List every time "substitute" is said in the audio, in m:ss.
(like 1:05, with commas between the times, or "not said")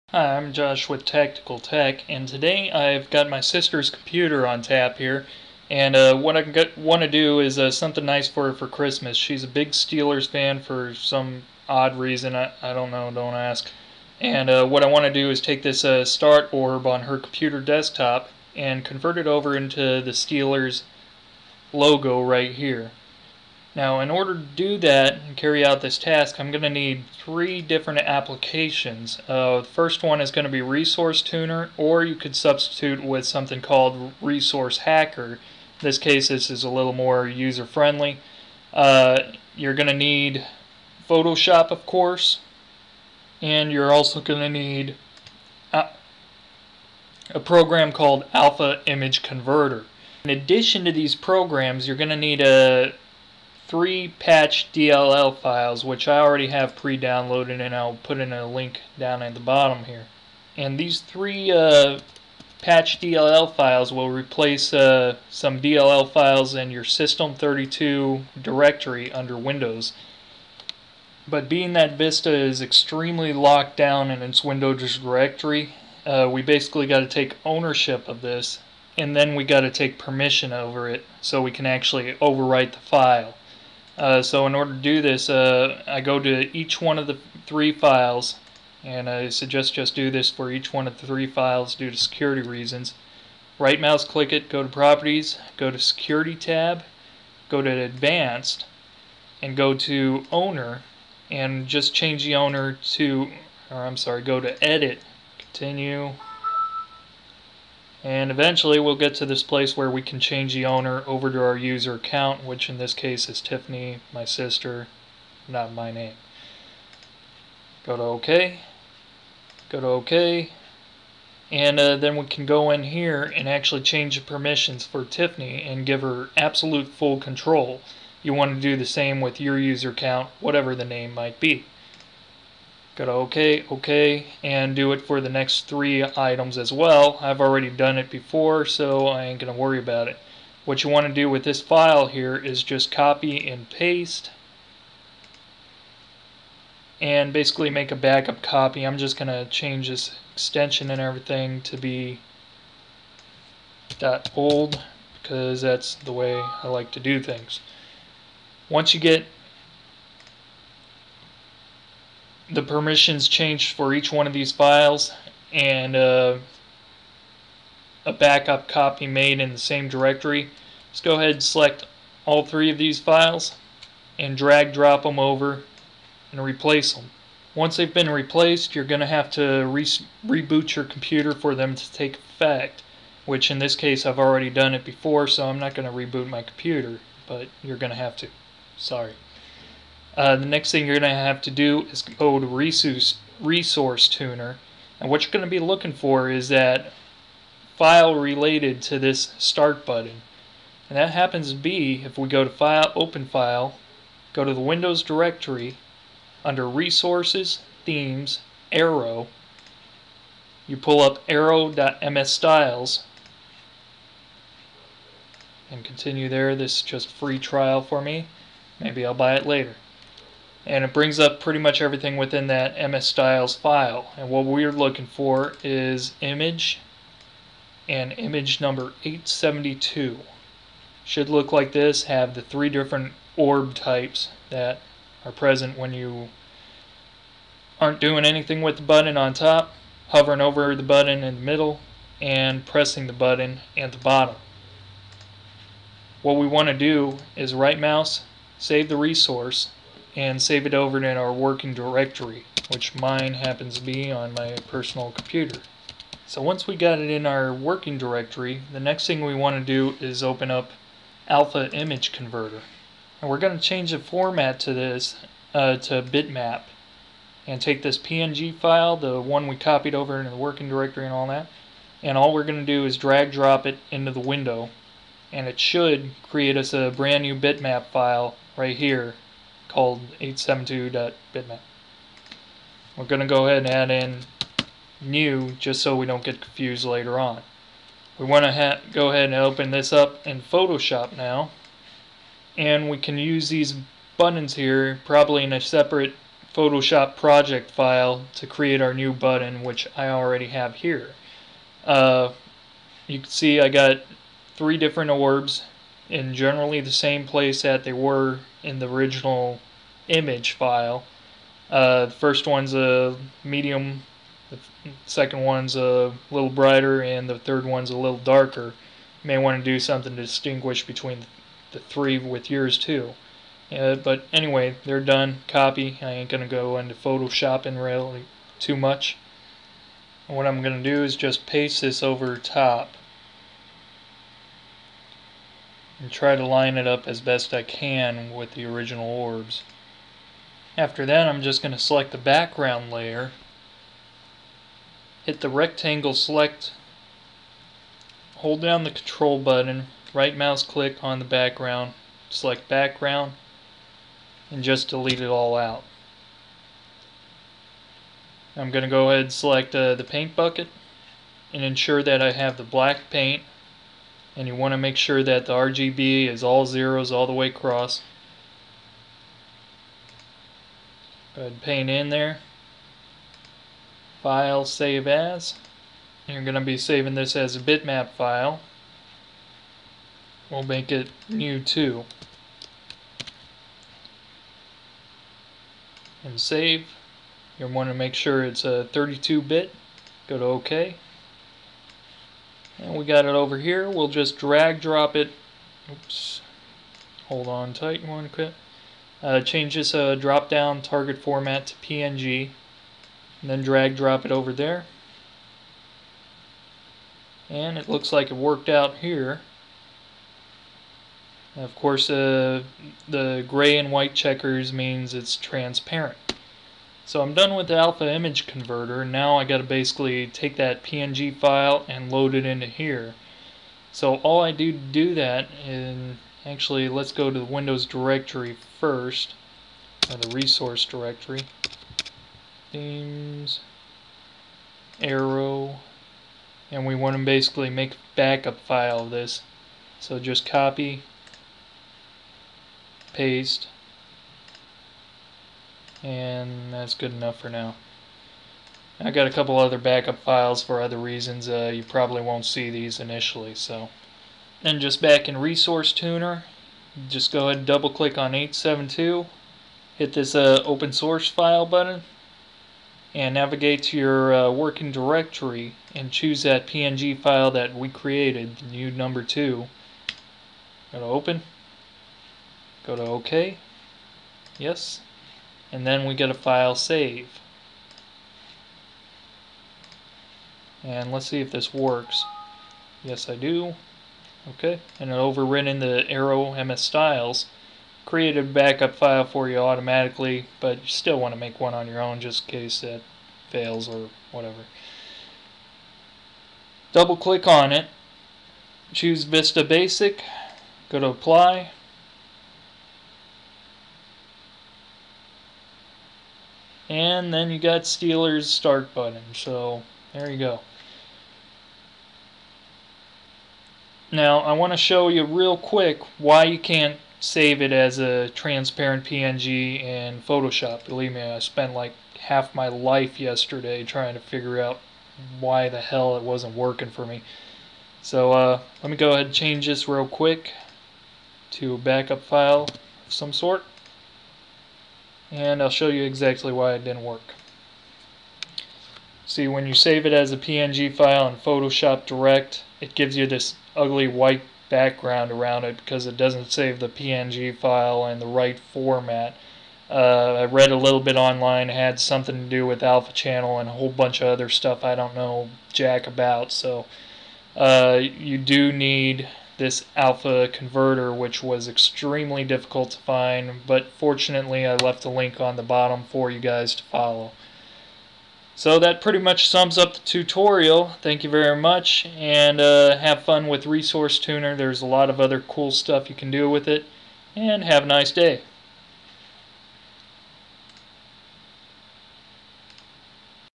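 0:32.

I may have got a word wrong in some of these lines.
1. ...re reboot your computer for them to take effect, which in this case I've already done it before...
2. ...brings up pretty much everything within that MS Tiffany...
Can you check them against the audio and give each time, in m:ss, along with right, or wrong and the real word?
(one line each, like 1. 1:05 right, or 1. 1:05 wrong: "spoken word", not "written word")
1. 2:59 right
2. 3:40 wrong: "Styles", not "Tiffany".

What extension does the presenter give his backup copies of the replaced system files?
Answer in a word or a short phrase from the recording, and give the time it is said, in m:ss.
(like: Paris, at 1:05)
.old, at 2:34.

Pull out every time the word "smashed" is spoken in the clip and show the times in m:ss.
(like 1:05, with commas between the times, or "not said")
not said.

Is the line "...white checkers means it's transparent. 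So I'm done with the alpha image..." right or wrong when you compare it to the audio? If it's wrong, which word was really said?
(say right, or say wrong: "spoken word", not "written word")
right.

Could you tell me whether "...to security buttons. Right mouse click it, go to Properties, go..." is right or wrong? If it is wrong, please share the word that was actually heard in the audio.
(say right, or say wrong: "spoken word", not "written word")
wrong: "reasons", not "buttons".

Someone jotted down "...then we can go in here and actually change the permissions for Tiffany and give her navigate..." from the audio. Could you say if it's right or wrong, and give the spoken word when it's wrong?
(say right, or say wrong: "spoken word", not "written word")
wrong: "absolute", not "navigate".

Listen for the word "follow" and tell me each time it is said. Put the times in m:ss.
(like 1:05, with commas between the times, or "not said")
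9:26.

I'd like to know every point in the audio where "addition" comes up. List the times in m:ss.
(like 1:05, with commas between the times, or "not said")
0:50.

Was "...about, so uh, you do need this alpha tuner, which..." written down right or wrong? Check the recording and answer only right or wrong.
wrong.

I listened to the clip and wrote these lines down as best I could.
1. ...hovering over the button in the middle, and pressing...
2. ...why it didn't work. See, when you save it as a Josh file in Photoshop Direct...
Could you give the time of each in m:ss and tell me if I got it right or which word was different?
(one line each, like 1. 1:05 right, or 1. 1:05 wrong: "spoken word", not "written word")
1. 4:00 right
2. 8:56 wrong: "PNG", not "Josh".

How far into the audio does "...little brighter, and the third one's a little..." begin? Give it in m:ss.
5:16.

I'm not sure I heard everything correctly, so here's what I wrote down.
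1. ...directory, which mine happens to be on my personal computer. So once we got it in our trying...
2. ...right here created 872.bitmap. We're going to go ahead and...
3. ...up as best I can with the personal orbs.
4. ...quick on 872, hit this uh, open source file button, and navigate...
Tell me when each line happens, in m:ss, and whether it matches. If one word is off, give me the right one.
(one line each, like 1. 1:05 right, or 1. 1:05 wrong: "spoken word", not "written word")
1. 4:11 wrong: "working", not "trying"
2. 4:38 wrong: "called", not "created"
3. 5:36 wrong: "original", not "personal"
4. 7:37 wrong: "click", not "quick".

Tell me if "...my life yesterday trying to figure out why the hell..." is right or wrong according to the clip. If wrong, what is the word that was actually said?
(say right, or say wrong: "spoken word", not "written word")
right.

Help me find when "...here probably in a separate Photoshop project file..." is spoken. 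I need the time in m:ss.
4:54.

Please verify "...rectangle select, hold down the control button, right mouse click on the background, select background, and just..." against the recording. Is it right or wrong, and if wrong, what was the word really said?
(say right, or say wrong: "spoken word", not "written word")
right.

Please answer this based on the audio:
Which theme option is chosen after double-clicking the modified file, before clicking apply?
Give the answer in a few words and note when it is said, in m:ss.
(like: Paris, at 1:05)
Vista Basic, at 8:19.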